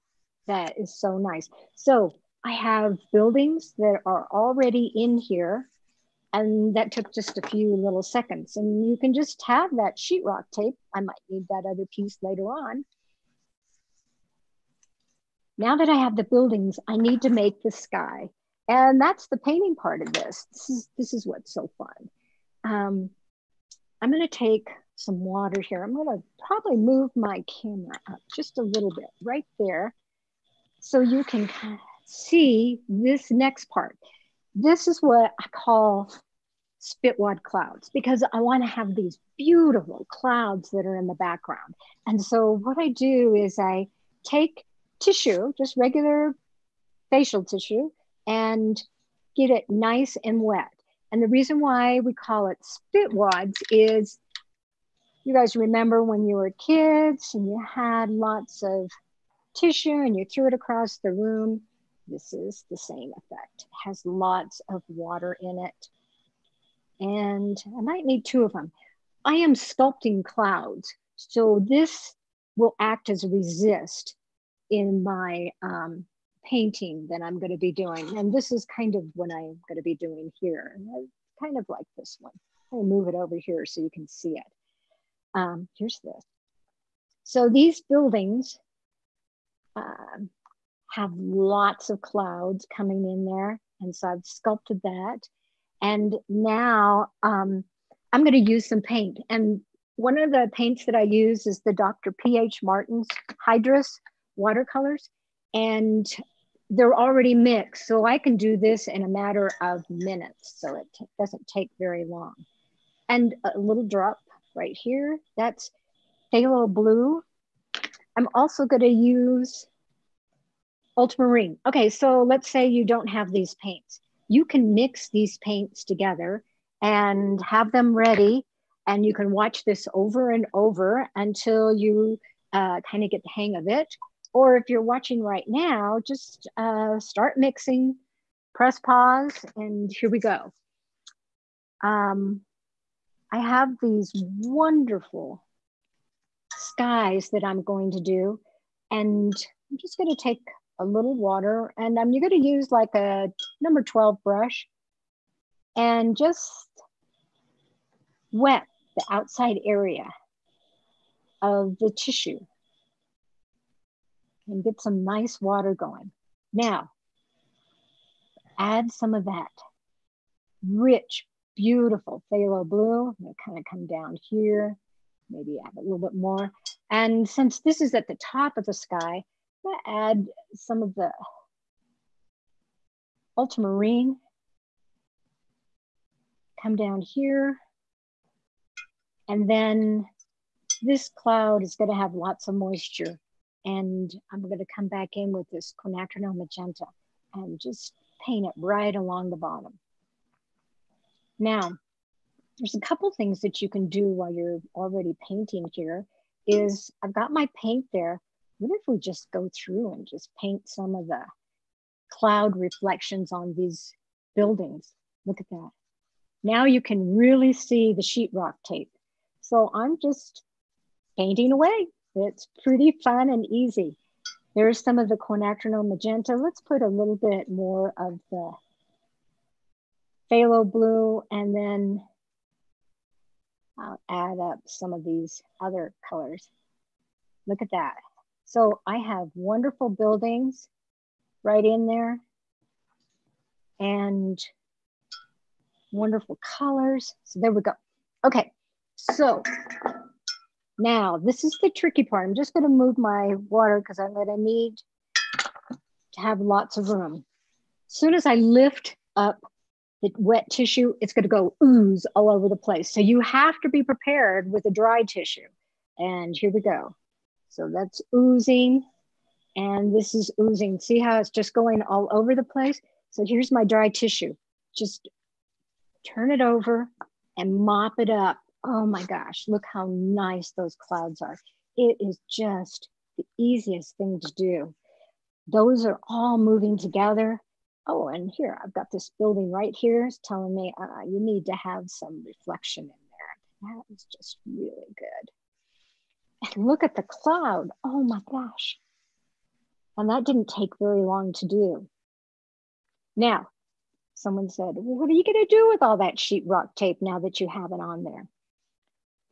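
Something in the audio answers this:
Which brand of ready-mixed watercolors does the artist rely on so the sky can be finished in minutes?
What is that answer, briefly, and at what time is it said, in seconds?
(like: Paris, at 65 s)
Dr. P.H. Martin's Hydrus, at 101 s.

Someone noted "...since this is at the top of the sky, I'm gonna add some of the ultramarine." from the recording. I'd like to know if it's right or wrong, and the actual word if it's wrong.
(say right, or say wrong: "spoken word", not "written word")
right.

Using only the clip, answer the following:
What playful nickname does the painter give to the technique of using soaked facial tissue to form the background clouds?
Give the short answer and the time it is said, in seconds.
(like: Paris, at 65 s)
Spitwad clouds, at 36 s.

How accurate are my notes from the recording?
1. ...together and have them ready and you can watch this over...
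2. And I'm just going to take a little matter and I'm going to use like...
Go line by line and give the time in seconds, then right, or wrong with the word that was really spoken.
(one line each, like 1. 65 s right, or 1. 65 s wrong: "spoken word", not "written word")
1. 125 s right
2. 148 s wrong: "water", not "matter".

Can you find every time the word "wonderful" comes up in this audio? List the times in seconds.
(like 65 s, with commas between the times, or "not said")
144 s, 239 s, 245 s.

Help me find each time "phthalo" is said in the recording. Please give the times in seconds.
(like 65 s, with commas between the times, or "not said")
116 s, 172 s, 230 s.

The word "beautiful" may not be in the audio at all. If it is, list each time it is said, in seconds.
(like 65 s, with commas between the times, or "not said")
39 s, 171 s.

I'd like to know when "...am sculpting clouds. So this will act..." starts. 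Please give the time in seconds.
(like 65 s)
69 s.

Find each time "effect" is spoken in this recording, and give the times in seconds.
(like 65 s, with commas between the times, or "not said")
63 s.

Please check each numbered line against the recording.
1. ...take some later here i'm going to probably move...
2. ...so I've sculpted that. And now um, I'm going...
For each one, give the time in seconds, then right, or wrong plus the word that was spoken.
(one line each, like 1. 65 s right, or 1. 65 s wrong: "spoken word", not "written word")
1. 24 s wrong: "water", not "later"
2. 93 s right.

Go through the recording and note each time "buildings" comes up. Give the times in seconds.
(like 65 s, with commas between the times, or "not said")
3 s, 16 s, 87 s, 214 s, 239 s, 289 s.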